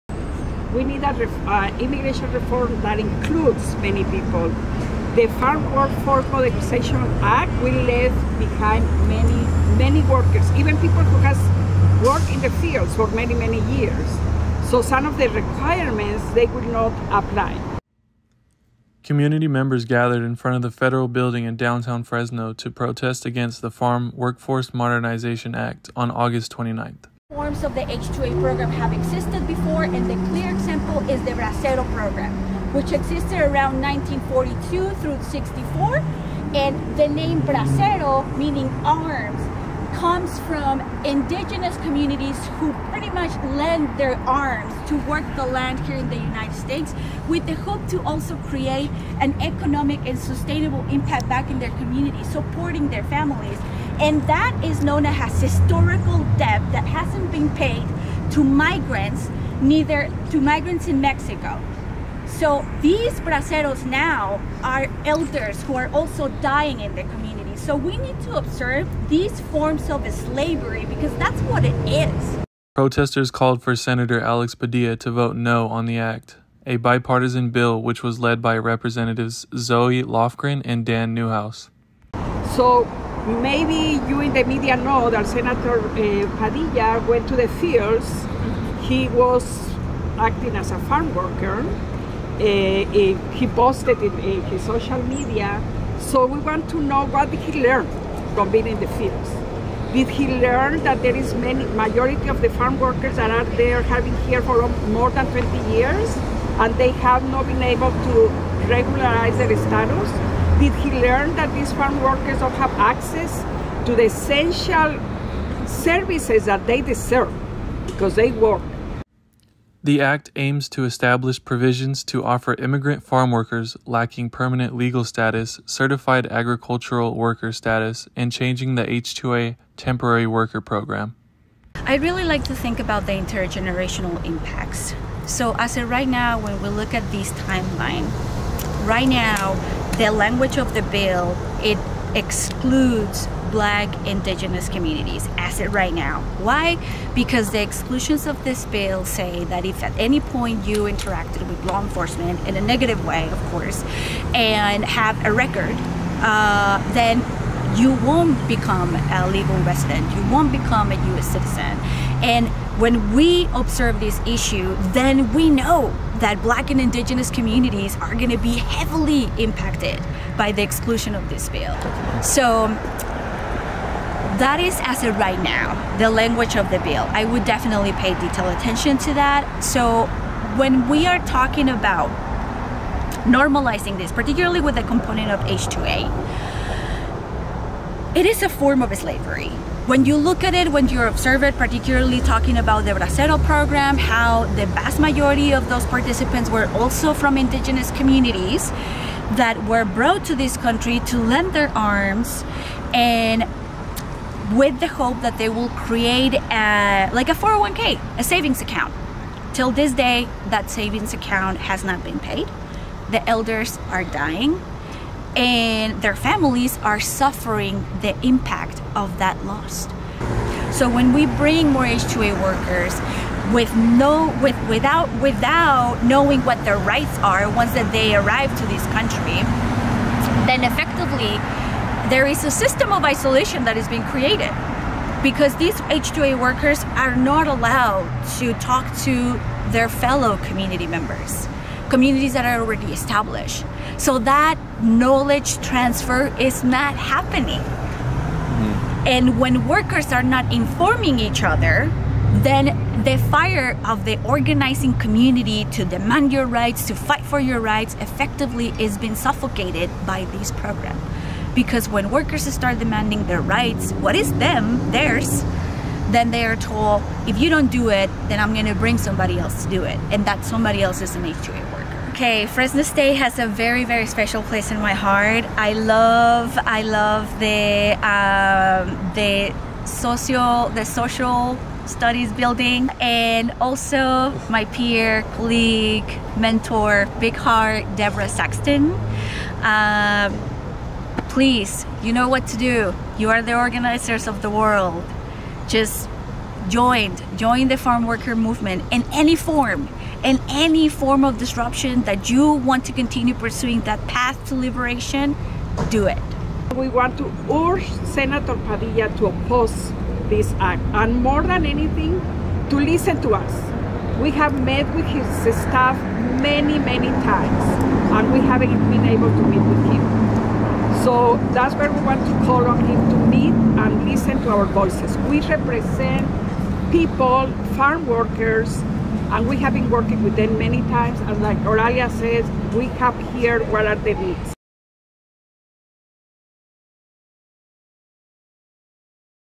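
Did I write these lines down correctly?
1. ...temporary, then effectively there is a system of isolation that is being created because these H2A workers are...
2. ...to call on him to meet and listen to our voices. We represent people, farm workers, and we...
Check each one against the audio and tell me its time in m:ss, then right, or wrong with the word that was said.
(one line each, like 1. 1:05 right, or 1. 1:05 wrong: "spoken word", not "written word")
1. 3:48 wrong: "country", not "temporary"
2. 5:22 right.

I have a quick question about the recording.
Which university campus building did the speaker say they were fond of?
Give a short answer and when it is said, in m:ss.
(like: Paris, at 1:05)
Social studies building, at 4:40.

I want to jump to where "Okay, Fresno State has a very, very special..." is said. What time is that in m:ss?
4:32.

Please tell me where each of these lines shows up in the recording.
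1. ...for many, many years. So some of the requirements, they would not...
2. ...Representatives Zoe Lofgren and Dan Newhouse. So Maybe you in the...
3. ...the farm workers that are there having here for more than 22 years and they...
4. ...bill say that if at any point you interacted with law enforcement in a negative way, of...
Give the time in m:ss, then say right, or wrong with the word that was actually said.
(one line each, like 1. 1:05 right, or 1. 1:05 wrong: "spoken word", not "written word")
1. 0:12 right
2. 1:18 right
3. 1:42 wrong: "20", not "22"
4. 2:28 right.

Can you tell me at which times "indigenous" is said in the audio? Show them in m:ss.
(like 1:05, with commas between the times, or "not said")
0:41, 2:24, 2:46, 3:17.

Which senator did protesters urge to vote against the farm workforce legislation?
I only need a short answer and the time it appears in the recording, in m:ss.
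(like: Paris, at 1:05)
Alex Padilla, at 1:14.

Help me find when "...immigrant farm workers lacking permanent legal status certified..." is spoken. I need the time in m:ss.
2:02.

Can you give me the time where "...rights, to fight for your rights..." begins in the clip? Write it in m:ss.
4:16.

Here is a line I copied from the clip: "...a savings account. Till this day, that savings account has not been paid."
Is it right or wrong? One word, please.
right.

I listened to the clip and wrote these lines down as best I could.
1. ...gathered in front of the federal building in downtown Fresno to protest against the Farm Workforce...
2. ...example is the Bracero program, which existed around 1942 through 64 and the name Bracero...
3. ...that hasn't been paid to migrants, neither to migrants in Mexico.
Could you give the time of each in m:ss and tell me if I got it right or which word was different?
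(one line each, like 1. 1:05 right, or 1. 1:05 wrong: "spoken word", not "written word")
1. 0:19 right
2. 0:30 right
3. 0:56 right.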